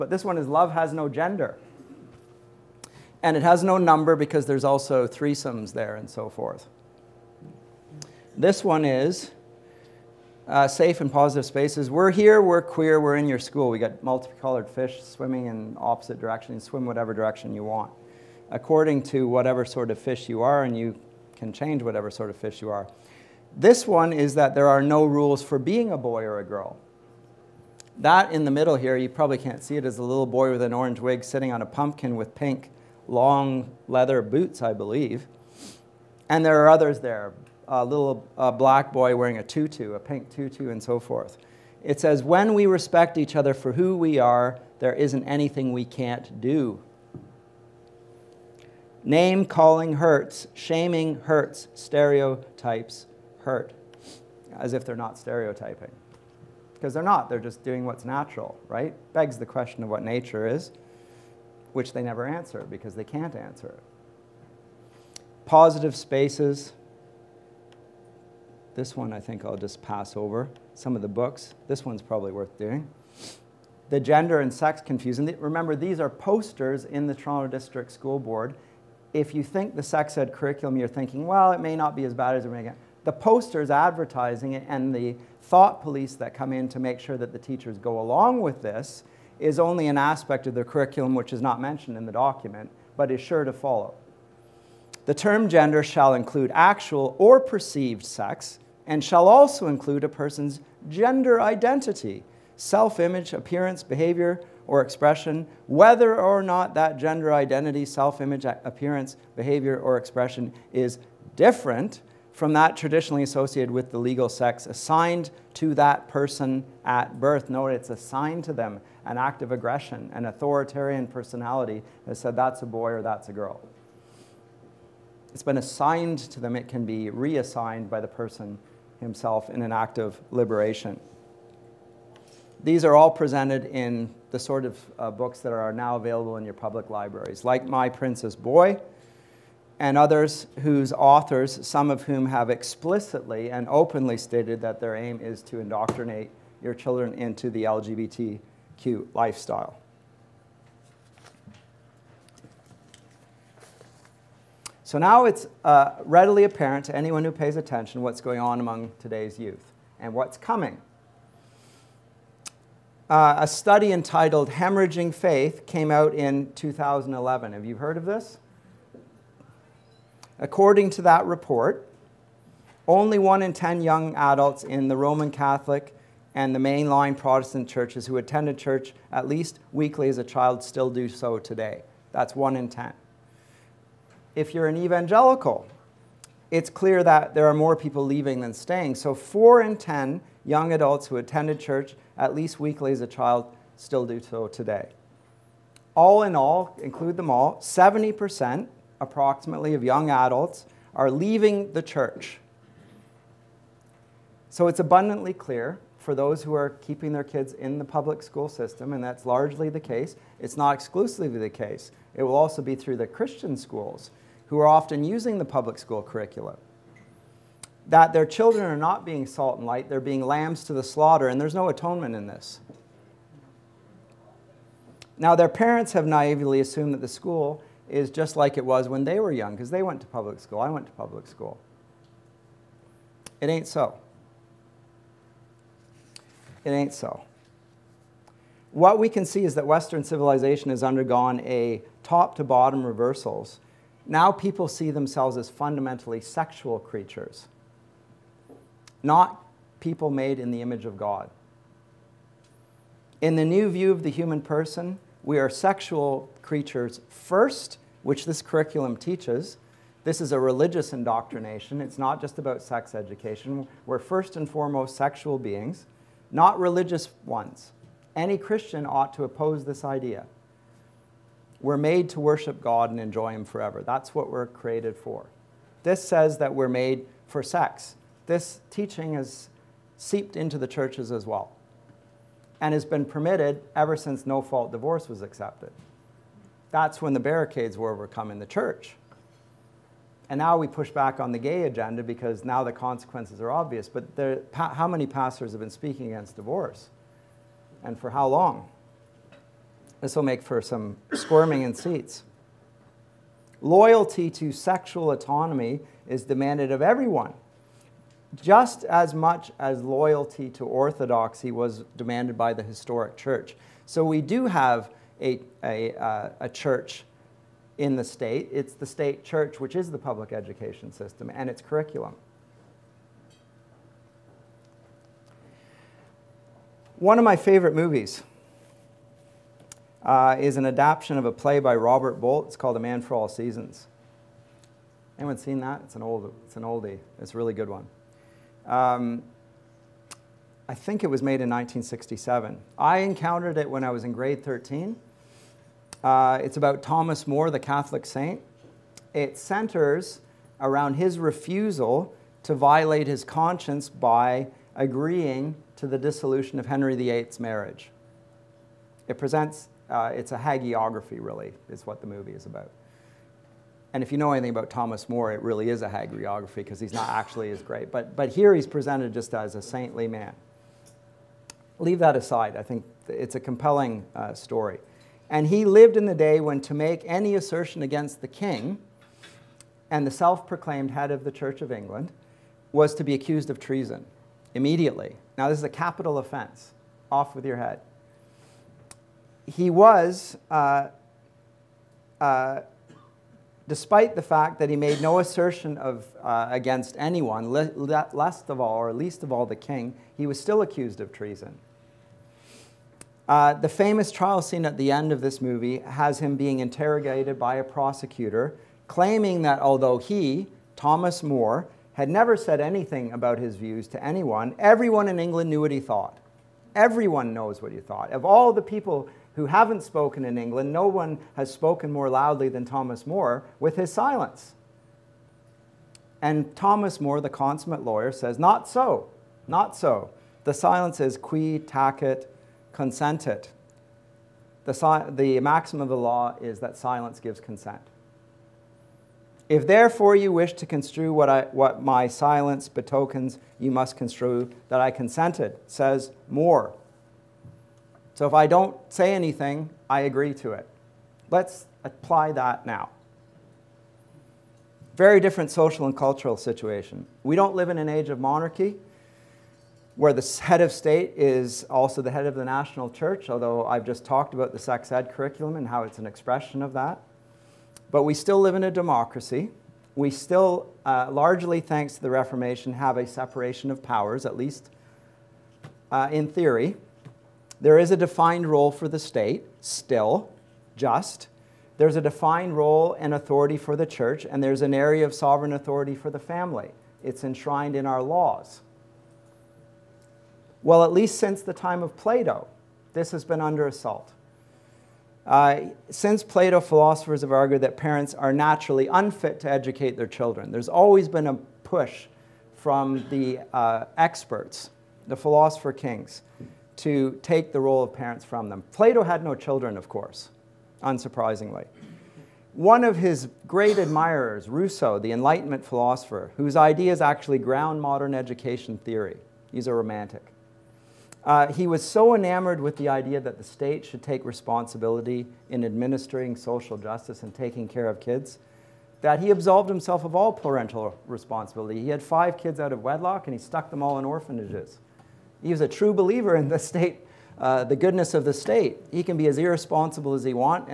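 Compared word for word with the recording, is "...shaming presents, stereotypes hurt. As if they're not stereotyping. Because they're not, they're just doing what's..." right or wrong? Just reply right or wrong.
wrong.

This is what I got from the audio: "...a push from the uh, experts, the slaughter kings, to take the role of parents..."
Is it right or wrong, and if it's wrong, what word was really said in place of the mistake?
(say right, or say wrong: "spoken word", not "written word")
wrong: "philosopher", not "slaughter".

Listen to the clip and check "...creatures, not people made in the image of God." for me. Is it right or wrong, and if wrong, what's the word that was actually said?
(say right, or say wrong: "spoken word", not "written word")
right.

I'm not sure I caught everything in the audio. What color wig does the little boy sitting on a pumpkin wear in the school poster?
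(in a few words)
orange.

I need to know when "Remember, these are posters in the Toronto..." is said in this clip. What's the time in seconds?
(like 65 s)
75 s.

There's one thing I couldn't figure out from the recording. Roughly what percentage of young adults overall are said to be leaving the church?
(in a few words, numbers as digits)
70%.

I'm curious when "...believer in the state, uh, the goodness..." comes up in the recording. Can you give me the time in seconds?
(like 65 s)
535 s.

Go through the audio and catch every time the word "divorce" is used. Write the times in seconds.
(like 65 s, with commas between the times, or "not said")
284 s, 296 s.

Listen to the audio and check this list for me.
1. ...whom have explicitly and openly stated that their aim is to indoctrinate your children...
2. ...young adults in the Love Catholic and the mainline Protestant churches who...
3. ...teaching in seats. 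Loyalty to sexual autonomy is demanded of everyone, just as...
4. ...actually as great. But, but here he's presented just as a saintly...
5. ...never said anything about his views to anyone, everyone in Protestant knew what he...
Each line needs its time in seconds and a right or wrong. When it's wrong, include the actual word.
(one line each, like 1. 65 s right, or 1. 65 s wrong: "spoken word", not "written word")
1. 142 s right
2. 173 s wrong: "Roman", not "Love"
3. 301 s wrong: "squirming", not "teaching"
4. 367 s right
5. 412 s wrong: "England", not "Protestant".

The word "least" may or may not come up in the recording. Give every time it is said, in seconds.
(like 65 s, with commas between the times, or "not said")
179 s, 192 s, 398 s, 474 s, 490 s.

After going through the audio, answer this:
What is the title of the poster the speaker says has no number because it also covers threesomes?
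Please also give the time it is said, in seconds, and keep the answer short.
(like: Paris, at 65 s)
Love Has No Gender, at 0 s.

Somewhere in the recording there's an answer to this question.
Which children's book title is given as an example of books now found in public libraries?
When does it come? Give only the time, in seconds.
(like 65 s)
137 s.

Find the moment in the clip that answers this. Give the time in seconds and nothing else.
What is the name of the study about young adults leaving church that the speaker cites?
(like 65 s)
164 s.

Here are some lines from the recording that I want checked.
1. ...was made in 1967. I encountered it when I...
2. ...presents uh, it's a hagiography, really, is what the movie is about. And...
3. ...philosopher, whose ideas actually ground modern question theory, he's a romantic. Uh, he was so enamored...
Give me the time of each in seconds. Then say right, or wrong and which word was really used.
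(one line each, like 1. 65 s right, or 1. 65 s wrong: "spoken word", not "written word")
1. 341 s right
2. 359 s right
3. 515 s wrong: "education", not "question".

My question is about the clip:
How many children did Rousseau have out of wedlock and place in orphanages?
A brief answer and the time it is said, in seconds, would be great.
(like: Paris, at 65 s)
5, at 532 s.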